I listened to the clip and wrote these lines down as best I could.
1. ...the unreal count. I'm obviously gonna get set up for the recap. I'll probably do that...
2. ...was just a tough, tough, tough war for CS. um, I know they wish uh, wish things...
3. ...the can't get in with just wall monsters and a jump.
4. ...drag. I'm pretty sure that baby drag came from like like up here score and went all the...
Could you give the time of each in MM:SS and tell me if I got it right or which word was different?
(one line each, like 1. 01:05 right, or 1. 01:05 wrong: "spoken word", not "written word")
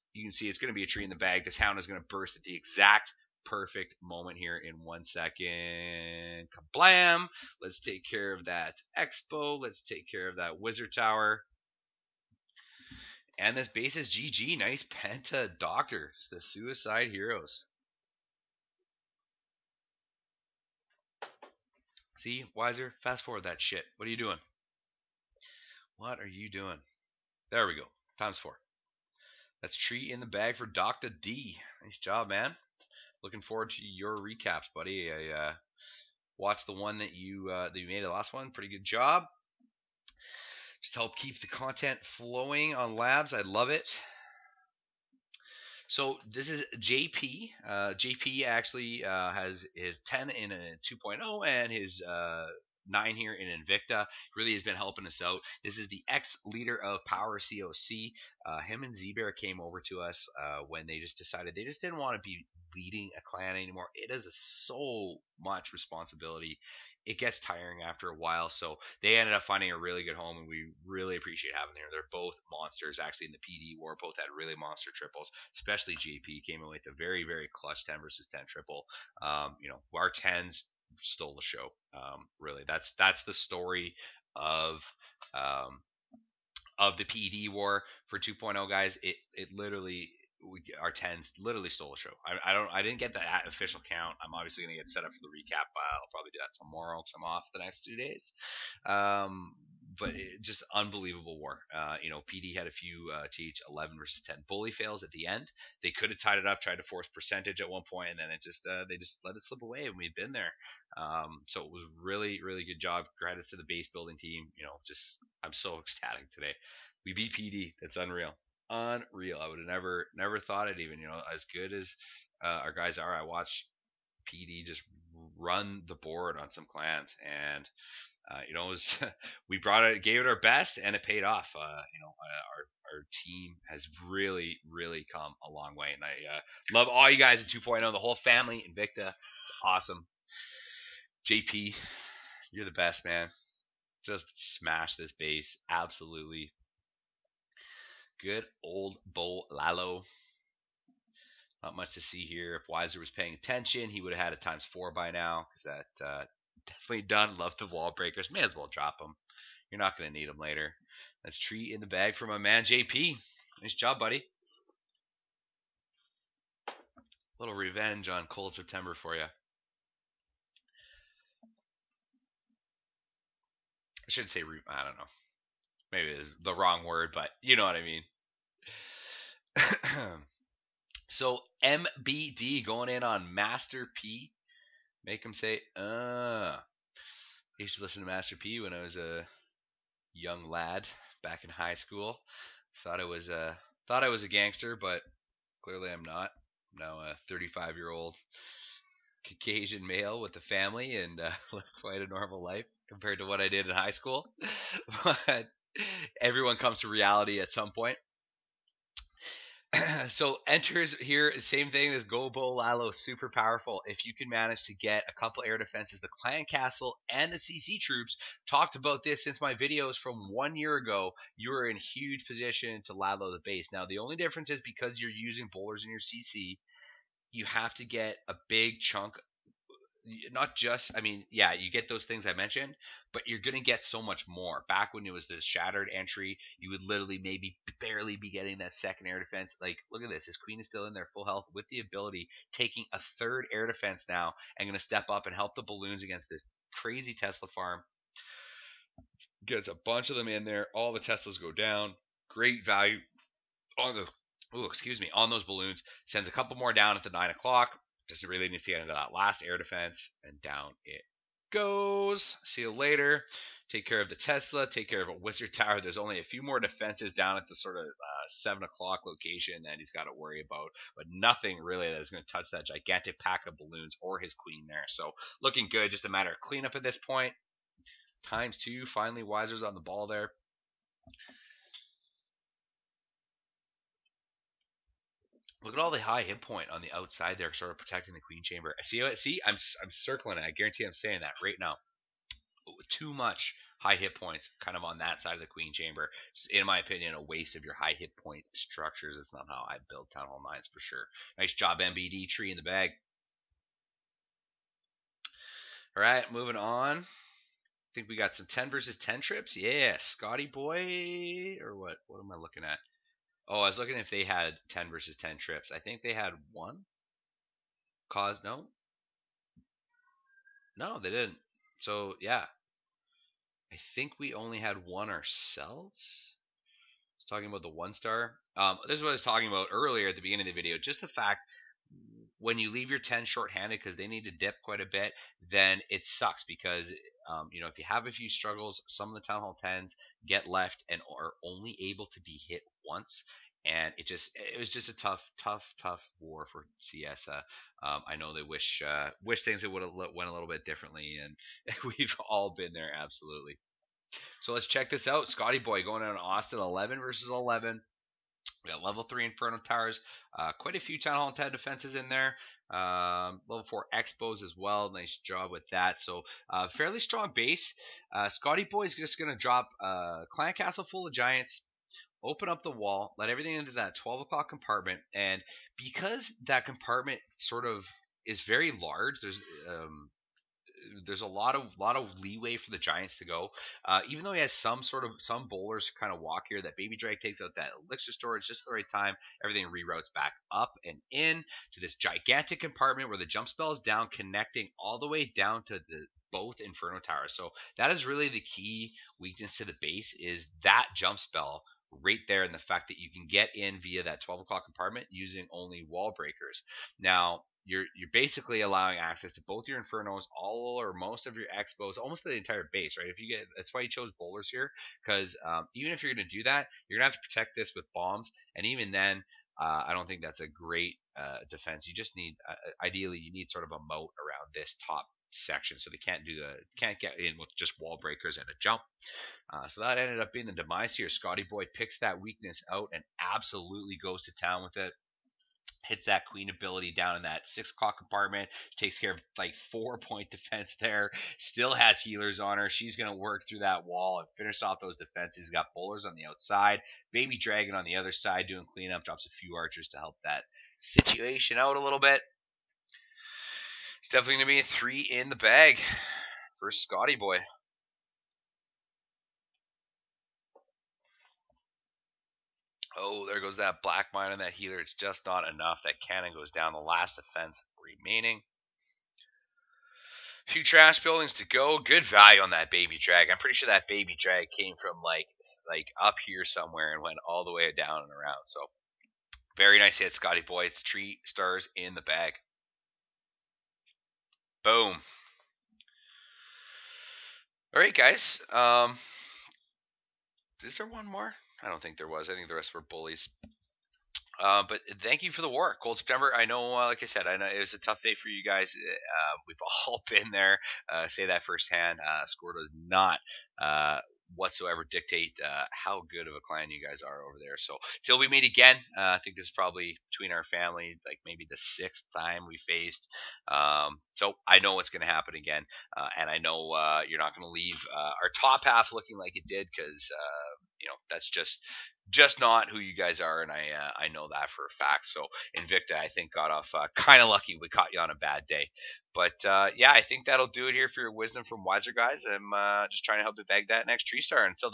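1. 01:33 wrong: "official", not "unreal"
2. 05:44 right
3. 07:06 wrong: "breakers", not "monsters"
4. 07:53 wrong: "somewhere", not "score".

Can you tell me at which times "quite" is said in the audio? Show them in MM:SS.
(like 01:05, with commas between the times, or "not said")
03:21, 05:34, 06:00.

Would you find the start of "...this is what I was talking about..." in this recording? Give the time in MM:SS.
05:28.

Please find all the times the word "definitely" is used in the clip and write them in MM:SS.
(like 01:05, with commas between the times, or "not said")
02:36, 07:34.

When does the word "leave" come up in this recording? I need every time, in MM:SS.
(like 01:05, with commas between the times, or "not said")
05:32, 08:37.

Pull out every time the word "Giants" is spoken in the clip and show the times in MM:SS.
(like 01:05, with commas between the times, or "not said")
06:11, 06:22.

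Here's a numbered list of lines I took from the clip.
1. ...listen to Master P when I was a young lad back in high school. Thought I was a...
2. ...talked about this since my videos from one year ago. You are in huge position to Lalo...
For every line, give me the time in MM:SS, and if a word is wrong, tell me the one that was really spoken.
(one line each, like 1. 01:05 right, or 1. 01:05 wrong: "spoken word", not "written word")
1. 03:07 right
2. 03:38 right.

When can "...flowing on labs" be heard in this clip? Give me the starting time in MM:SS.
00:42.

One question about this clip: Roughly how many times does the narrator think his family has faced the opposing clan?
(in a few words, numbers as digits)
6.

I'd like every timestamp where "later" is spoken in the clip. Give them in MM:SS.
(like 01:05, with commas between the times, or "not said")
02:40, 04:22.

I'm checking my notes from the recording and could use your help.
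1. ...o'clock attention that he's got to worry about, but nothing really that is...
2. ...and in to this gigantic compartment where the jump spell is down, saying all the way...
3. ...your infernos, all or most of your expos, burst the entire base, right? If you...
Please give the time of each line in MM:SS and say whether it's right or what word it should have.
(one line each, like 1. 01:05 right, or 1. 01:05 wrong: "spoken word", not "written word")
1. 04:28 wrong: "location", not "attention"
2. 06:30 wrong: "connecting", not "saying"
3. 06:49 wrong: "almost", not "burst".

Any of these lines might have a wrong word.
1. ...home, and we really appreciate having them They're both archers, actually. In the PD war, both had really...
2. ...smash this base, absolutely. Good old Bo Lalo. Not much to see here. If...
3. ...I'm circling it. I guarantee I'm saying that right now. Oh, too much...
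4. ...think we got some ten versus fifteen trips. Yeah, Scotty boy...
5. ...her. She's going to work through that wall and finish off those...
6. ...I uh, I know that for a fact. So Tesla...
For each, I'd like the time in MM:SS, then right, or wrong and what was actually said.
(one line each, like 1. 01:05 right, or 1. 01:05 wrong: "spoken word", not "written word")
1. 01:10 wrong: "monsters", not "archers"
2. 02:24 right
3. 04:49 right
4. 05:07 wrong: "ten", not "fifteen"
5. 07:22 right
6. 08:43 wrong: "Invicta", not "Tesla".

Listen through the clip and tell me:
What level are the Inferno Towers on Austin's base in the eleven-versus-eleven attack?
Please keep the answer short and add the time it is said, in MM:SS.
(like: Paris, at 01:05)
3, at 05:58.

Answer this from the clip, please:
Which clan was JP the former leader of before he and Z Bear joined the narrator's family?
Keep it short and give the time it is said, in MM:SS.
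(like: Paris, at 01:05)
Power COC, at 00:57.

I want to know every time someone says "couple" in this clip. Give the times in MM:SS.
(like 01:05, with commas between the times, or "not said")
03:35, 04:16.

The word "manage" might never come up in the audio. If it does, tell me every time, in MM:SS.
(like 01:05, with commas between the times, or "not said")
03:34.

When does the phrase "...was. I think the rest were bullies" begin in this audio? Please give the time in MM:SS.
08:12.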